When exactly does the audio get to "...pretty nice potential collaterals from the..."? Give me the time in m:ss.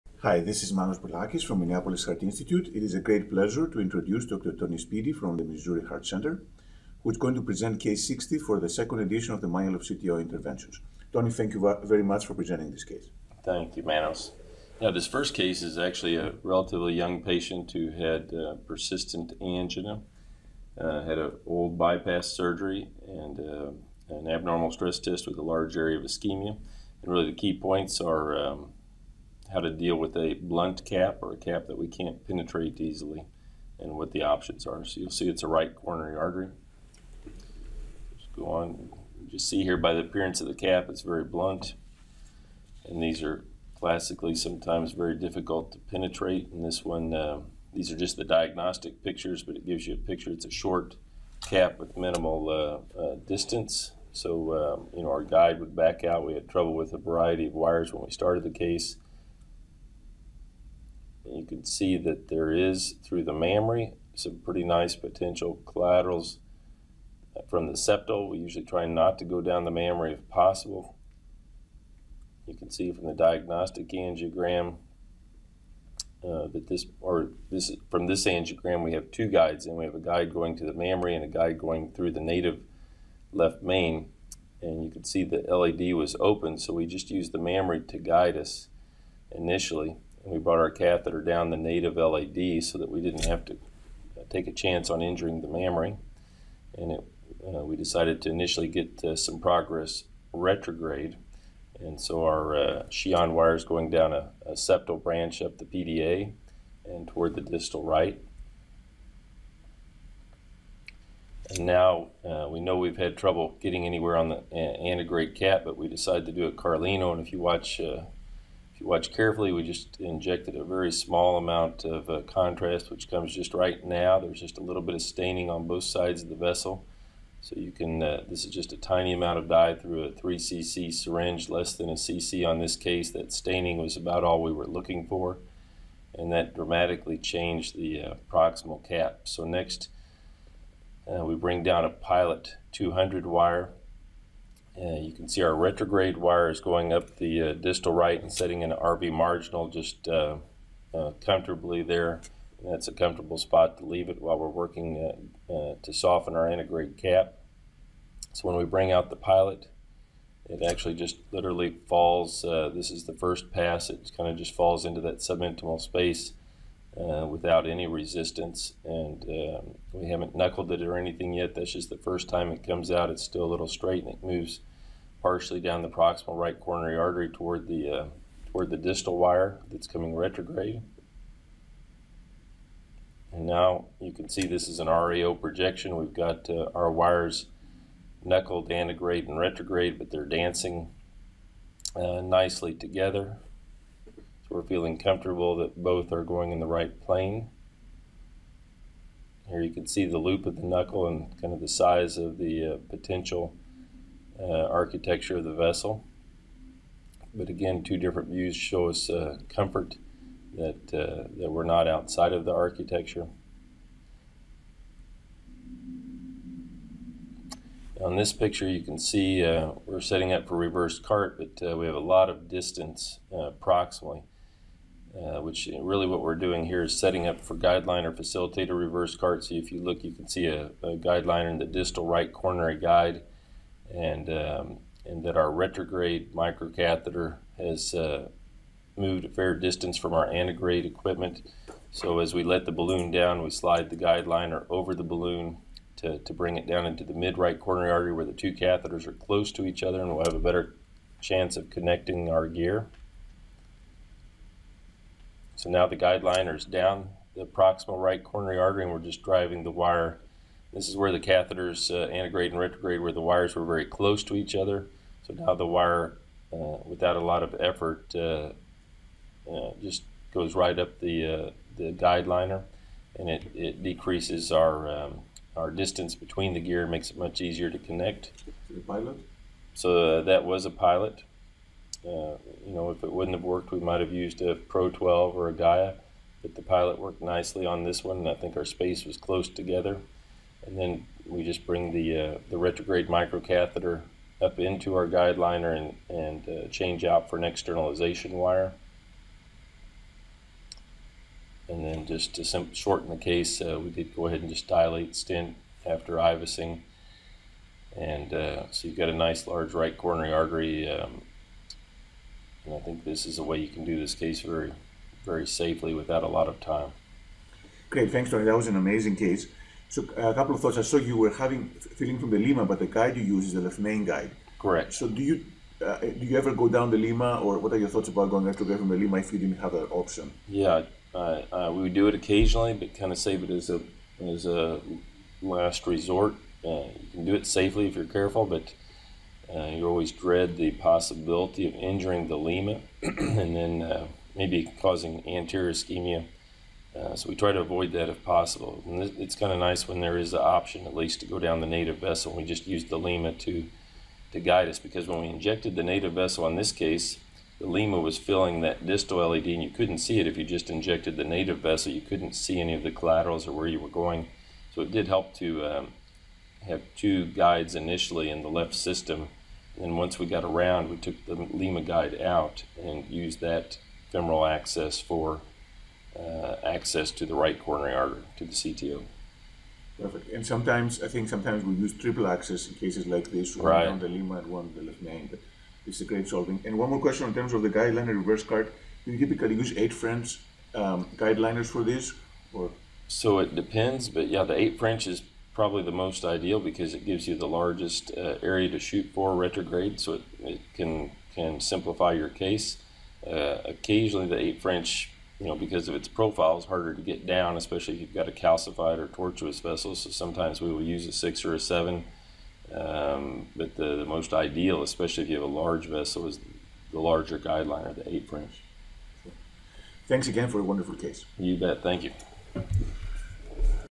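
1:04.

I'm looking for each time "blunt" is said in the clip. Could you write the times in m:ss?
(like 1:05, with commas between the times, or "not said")
0:30, 0:41.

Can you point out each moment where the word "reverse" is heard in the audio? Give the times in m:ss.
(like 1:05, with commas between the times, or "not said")
3:40, 3:48, 6:28.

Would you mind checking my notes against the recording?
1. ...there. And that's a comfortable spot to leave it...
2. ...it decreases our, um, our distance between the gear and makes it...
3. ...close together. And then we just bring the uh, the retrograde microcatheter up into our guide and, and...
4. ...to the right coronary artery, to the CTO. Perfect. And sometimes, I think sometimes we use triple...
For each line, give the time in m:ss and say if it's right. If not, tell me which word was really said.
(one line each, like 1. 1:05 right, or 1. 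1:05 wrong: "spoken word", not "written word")
1. 2:31 right
2. 4:33 right
3. 4:49 right
4. 6:17 right.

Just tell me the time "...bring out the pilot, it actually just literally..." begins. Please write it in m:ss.
2:38.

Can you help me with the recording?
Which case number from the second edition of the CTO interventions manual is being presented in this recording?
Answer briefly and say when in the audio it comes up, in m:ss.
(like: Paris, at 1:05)
60, at 0:07.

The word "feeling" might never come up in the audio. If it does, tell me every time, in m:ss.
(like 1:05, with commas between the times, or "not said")
3:14, 5:21.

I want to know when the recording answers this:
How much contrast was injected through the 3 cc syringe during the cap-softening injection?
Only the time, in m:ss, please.
2:11.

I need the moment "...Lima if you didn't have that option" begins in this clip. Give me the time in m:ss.
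5:28.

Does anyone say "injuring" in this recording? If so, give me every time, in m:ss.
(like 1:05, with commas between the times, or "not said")
1:35, 5:41.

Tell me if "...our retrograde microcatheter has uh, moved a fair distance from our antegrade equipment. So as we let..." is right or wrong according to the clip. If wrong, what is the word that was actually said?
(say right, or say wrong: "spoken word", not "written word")
right.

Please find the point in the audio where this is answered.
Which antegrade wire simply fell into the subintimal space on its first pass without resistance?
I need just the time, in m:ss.
2:21.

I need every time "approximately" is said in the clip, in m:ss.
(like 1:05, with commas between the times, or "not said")
3:43.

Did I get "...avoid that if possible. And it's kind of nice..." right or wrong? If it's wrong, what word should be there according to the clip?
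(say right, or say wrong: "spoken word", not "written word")
right.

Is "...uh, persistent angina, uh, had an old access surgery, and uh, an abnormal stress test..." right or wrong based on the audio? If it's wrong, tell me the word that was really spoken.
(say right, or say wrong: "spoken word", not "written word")
wrong: "bypass", not "access".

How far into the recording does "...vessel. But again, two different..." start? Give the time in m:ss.
3:25.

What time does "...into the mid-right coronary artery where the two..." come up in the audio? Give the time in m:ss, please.
4:06.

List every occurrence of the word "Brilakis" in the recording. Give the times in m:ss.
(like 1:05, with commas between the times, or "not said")
0:00.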